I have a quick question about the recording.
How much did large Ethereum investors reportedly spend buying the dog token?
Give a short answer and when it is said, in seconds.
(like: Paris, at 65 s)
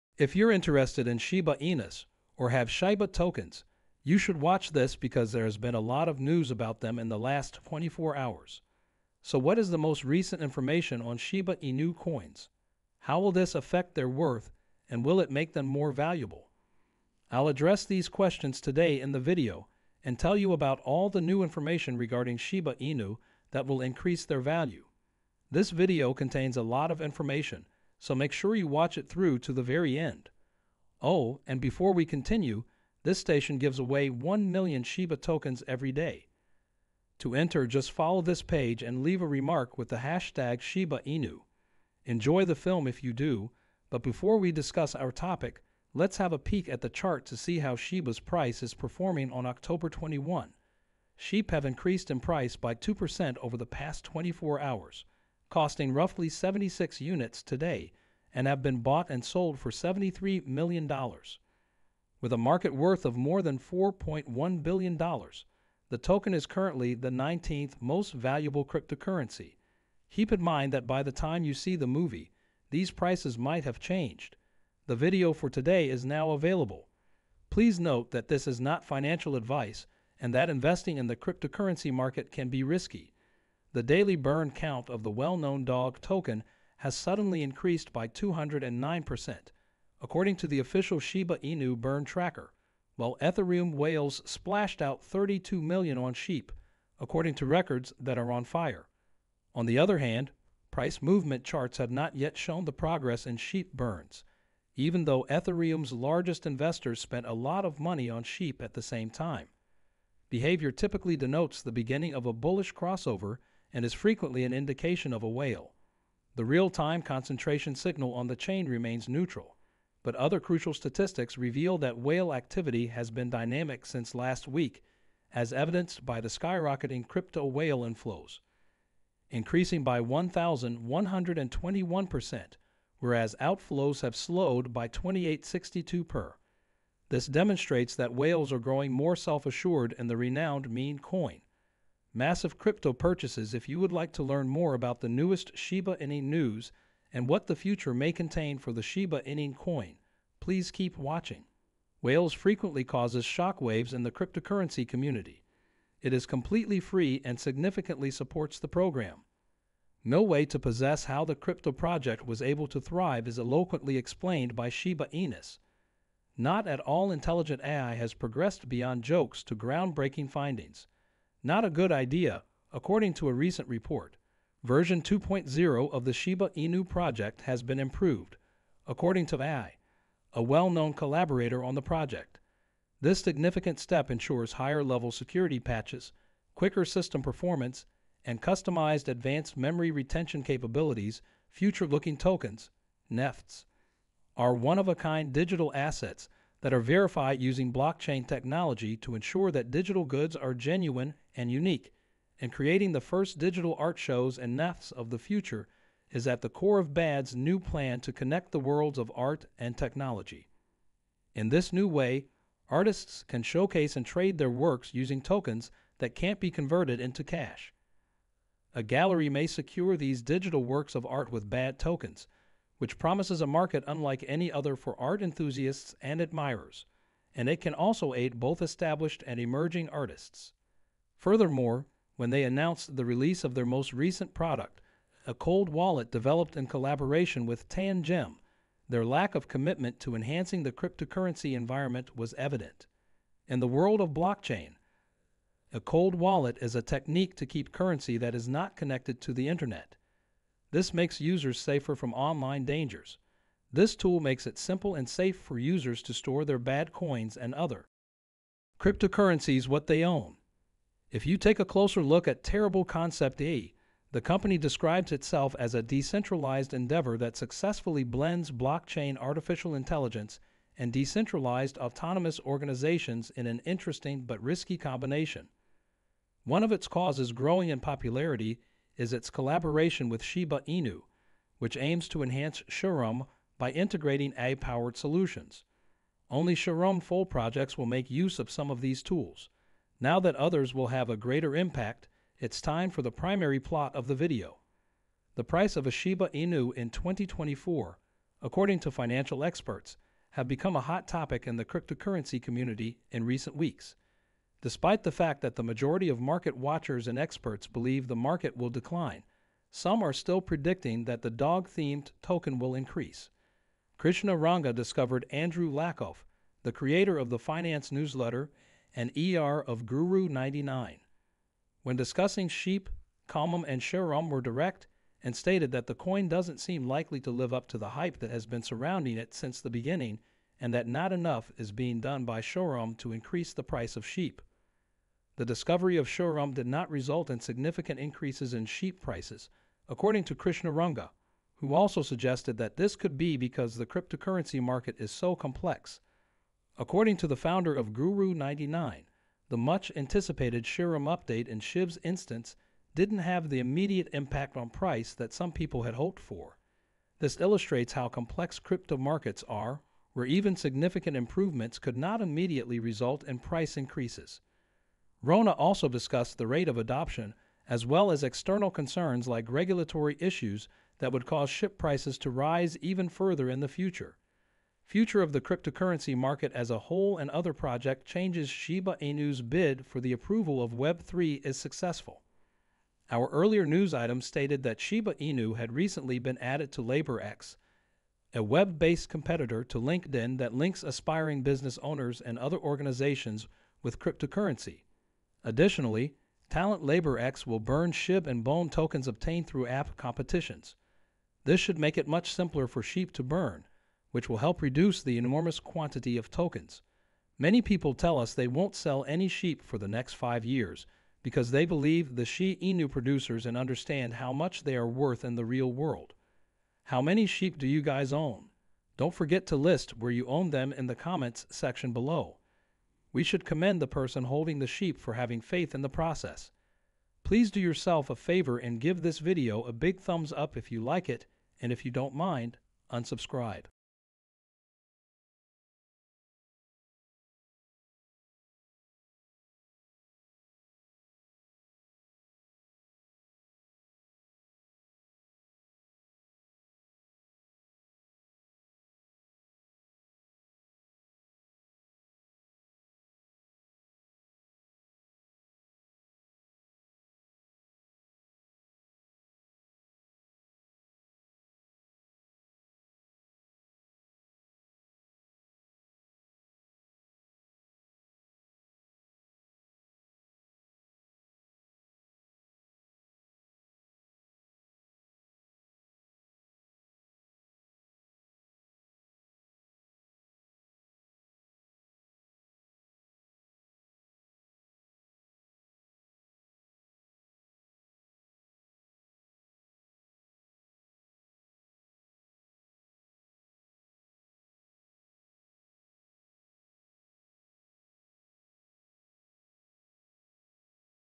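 32 million, at 95 s.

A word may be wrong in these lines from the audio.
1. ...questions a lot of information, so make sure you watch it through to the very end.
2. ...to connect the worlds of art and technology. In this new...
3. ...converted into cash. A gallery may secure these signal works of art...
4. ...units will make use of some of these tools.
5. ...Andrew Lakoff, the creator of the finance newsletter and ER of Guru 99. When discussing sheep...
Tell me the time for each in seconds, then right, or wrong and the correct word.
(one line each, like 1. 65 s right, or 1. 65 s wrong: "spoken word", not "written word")
1. 26 s wrong: "contains", not "questions"
2. 208 s right
3. 216 s wrong: "digital", not "signal"
4. 287 s wrong: "projects", not "units"
5. 315 s right.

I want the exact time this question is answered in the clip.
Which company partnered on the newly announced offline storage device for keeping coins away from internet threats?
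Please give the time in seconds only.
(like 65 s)
237 s.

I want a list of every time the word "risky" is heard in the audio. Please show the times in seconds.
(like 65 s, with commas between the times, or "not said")
82 s, 274 s.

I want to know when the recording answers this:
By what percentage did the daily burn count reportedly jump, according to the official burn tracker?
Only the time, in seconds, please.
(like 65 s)
88 s.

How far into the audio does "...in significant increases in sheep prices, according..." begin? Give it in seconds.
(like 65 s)
337 s.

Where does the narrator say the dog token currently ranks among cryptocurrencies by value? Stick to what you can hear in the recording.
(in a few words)
19th.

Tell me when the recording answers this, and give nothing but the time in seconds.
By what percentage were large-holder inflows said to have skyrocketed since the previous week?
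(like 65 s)
130 s.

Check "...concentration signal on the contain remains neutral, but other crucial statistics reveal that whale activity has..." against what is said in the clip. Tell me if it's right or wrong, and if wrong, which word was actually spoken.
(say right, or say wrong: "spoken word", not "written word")
wrong: "chain", not "contain".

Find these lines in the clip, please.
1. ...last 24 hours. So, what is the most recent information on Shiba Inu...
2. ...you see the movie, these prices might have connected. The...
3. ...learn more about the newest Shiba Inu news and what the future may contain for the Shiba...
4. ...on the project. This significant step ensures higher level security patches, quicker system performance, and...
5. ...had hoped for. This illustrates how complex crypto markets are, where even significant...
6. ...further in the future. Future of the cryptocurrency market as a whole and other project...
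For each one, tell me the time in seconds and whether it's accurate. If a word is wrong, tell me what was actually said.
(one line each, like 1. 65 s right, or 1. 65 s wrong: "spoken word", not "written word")
1. 7 s right
2. 71 s wrong: "changed", not "connected"
3. 144 s right
4. 181 s right
5. 355 s right
6. 373 s right.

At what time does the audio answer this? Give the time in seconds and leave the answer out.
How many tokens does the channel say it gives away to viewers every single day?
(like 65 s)
34 s.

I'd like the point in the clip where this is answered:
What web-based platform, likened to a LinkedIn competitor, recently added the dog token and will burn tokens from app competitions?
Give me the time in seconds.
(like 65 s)
386 s.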